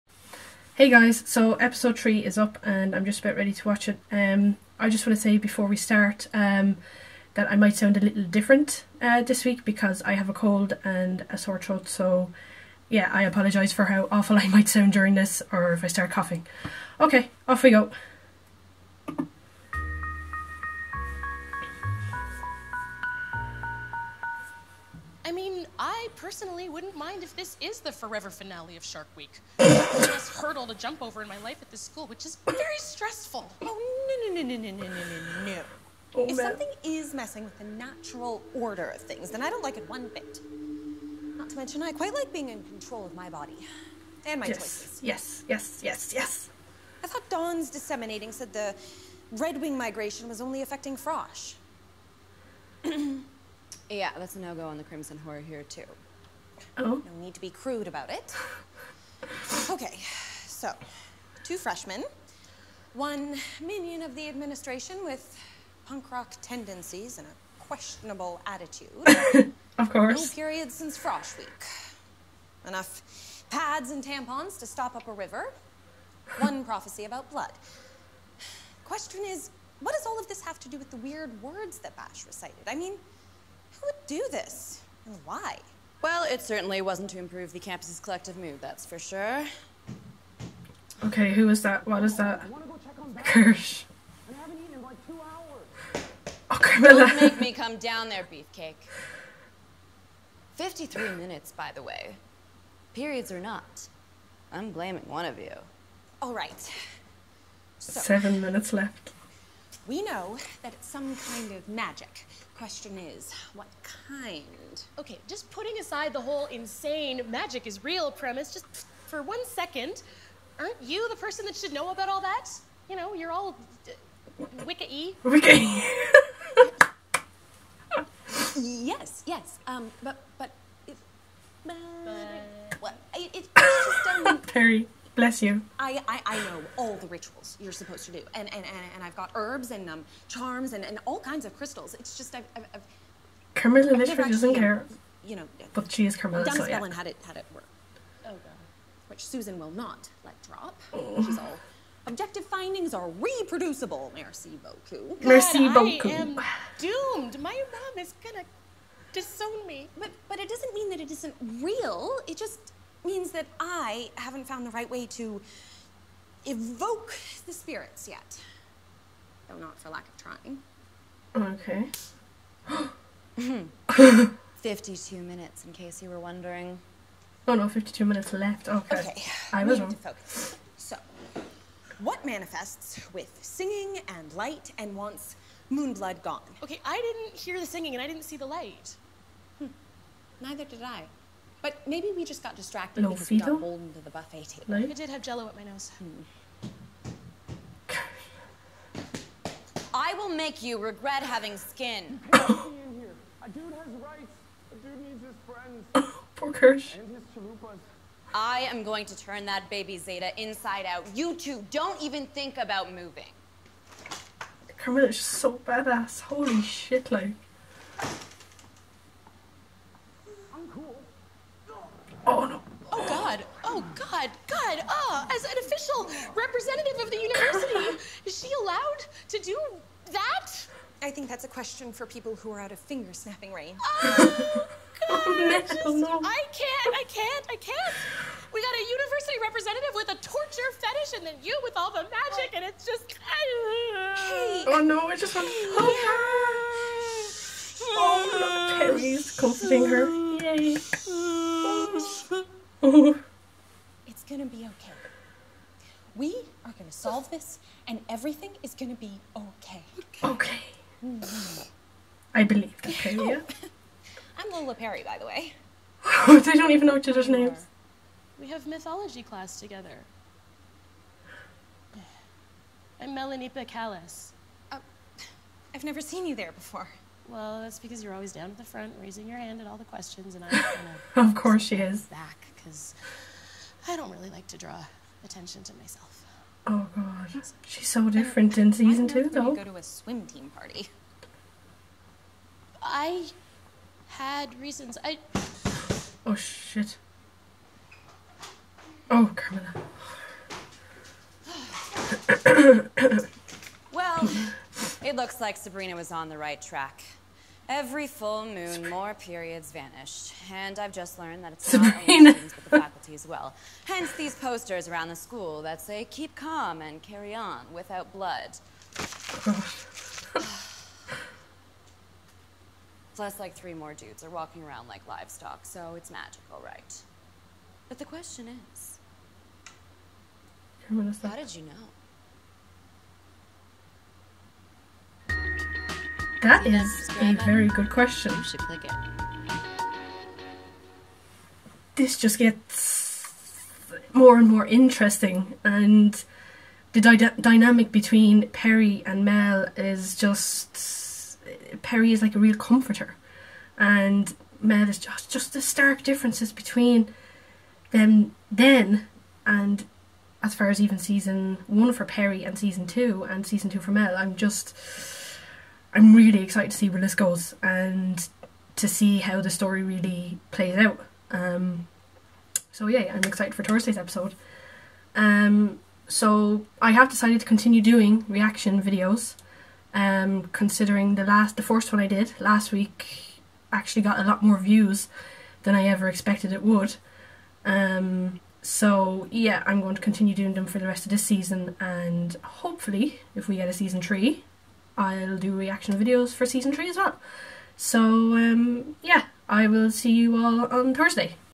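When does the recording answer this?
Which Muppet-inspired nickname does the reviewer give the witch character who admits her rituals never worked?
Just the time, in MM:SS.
02:23.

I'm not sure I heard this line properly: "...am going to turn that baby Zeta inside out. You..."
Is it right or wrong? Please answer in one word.
right.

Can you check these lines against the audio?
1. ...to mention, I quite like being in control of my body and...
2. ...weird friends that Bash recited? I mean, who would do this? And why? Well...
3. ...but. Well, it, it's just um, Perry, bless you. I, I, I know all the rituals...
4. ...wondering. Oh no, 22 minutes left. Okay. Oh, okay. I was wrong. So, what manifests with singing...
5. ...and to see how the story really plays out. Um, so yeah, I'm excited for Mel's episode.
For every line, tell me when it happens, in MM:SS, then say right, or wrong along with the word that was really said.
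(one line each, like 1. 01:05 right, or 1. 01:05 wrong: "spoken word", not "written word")
1. 00:41 right
2. 01:20 wrong: "words", not "friends"
3. 02:12 right
4. 02:56 wrong: "52", not "22"
5. 06:07 wrong: "Thursday", not "Mel".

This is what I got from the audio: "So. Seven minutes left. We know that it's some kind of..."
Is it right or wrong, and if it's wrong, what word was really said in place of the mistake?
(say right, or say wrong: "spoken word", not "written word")
right.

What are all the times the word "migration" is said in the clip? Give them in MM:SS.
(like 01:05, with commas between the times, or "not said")
00:49.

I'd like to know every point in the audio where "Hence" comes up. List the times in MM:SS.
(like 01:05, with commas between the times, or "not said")
05:13.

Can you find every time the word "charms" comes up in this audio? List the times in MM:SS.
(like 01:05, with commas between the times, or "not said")
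02:20.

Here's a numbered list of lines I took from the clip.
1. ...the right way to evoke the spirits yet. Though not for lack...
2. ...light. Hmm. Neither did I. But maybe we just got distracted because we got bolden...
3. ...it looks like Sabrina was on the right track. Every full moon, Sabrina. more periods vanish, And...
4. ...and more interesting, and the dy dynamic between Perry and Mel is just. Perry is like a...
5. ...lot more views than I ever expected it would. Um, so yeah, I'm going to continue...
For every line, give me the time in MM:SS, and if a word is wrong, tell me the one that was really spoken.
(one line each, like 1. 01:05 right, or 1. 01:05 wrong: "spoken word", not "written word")
1. 02:44 right
2. 03:08 right
3. 05:05 right
4. 05:44 right
5. 06:24 right.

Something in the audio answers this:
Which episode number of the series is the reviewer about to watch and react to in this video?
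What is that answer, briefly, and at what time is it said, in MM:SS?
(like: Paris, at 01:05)
3, at 00:01.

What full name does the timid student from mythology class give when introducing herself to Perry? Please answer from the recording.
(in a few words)
Melaniippe Callis.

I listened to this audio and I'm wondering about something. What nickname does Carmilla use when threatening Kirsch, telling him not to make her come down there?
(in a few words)
Beefcake.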